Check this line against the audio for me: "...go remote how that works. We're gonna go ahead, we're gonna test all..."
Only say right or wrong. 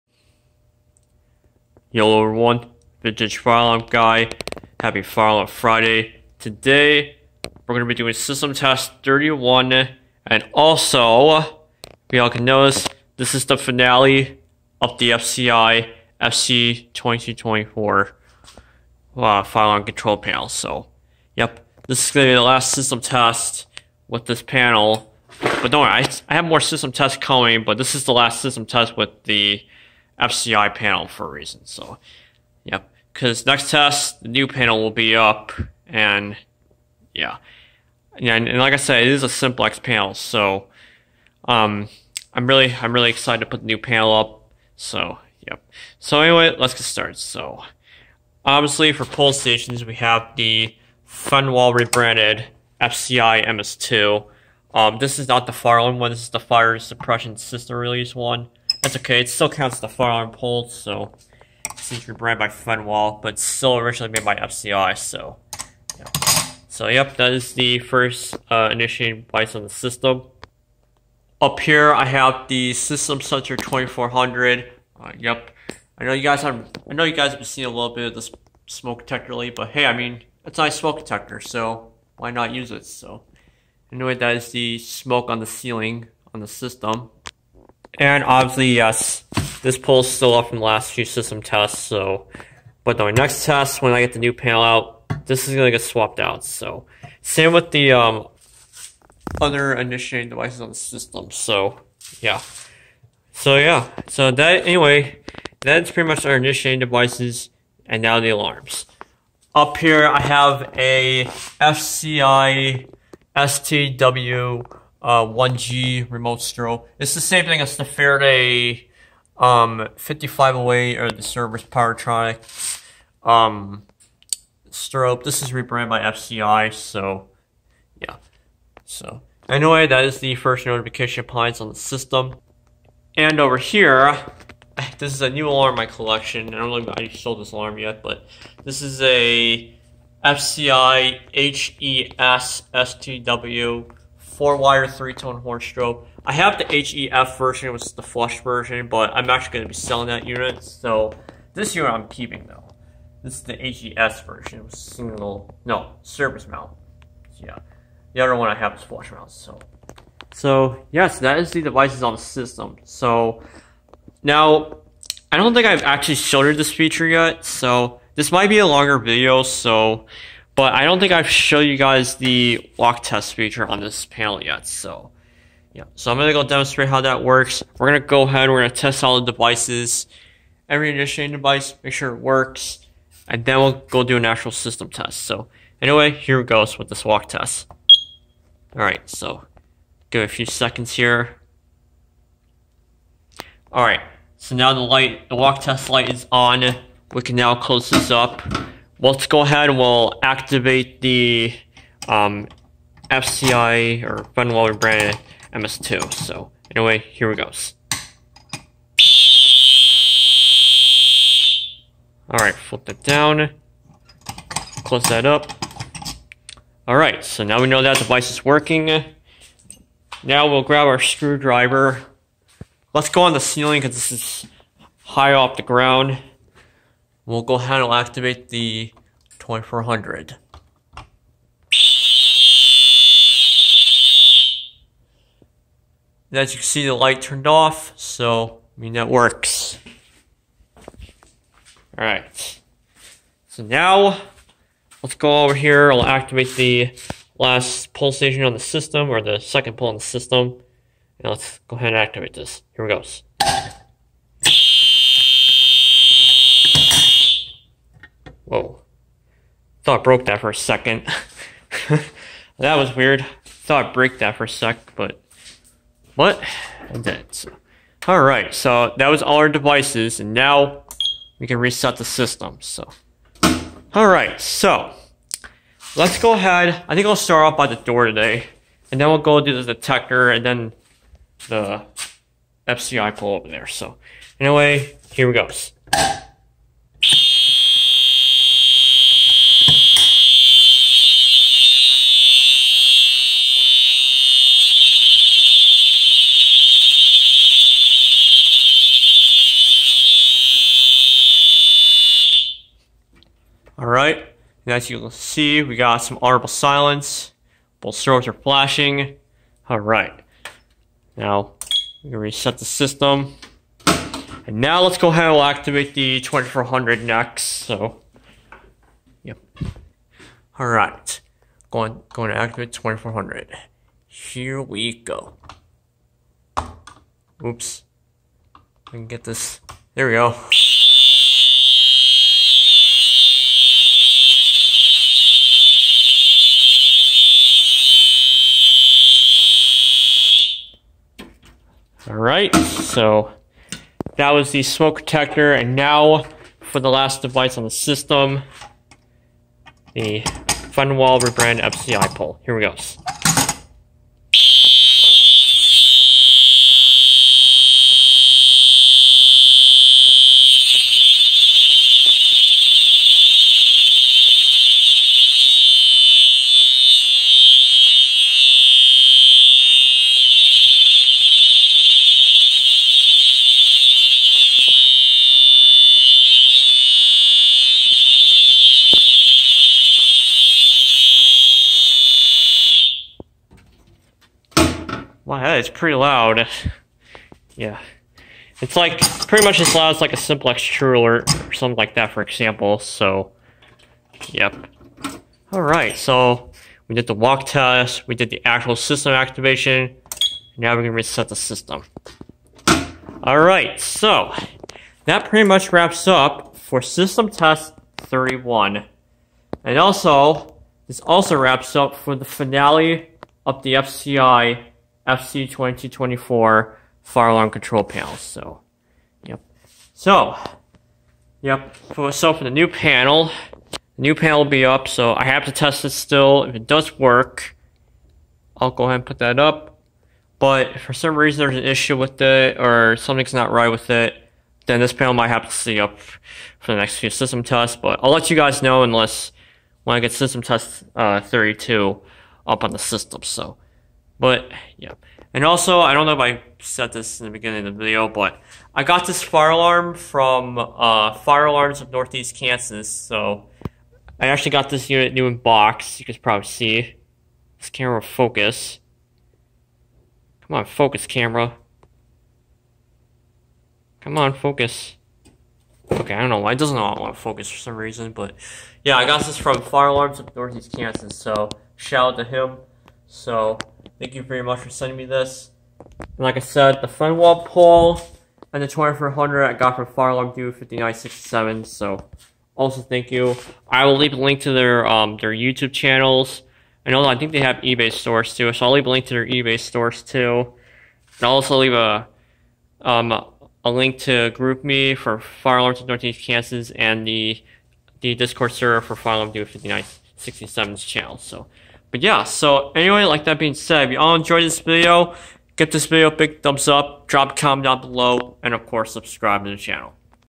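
wrong.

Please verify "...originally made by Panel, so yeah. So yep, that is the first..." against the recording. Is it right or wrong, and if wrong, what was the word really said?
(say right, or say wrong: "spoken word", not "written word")
wrong: "FCI", not "Panel".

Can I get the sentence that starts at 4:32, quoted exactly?
So, all right, so let's go ahead.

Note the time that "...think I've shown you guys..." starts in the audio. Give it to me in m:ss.
2:50.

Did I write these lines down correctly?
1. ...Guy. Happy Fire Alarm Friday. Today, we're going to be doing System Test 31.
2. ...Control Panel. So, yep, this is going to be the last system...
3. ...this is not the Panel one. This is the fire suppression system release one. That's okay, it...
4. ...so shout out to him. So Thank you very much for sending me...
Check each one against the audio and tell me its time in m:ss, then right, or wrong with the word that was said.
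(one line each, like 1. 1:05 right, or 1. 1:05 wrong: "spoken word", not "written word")
1. 0:03 right
2. 0:19 right
3. 0:54 wrong: "Farland", not "Panel"
4. 7:51 right.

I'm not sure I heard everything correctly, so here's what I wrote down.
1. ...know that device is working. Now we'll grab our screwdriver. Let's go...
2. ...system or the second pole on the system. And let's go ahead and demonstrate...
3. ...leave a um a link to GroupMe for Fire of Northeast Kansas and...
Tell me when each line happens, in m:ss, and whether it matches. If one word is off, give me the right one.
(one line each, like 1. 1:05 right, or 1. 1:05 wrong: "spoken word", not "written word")
1. 3:37 right
2. 4:08 wrong: "activate", not "demonstrate"
3. 8:11 right.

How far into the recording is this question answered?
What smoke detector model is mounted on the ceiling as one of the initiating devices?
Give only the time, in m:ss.
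1:12.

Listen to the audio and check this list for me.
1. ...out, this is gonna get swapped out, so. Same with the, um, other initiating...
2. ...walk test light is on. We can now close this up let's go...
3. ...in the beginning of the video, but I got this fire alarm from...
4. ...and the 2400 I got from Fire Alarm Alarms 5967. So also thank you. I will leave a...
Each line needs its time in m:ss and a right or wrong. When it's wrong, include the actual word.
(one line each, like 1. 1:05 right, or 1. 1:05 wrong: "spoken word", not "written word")
1. 1:34 right
2. 3:15 right
3. 7:27 right
4. 7:58 wrong: "Dude", not "Alarms".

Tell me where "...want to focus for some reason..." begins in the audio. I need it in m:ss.
7:46.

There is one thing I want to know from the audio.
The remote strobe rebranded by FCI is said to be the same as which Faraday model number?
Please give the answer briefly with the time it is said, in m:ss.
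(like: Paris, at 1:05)
5508, at 1:59.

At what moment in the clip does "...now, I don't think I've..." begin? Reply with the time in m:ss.
2:44.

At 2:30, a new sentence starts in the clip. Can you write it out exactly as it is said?
So this unit I'm keeping though.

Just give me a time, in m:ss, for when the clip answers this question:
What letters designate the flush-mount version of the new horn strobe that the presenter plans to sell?
2:26.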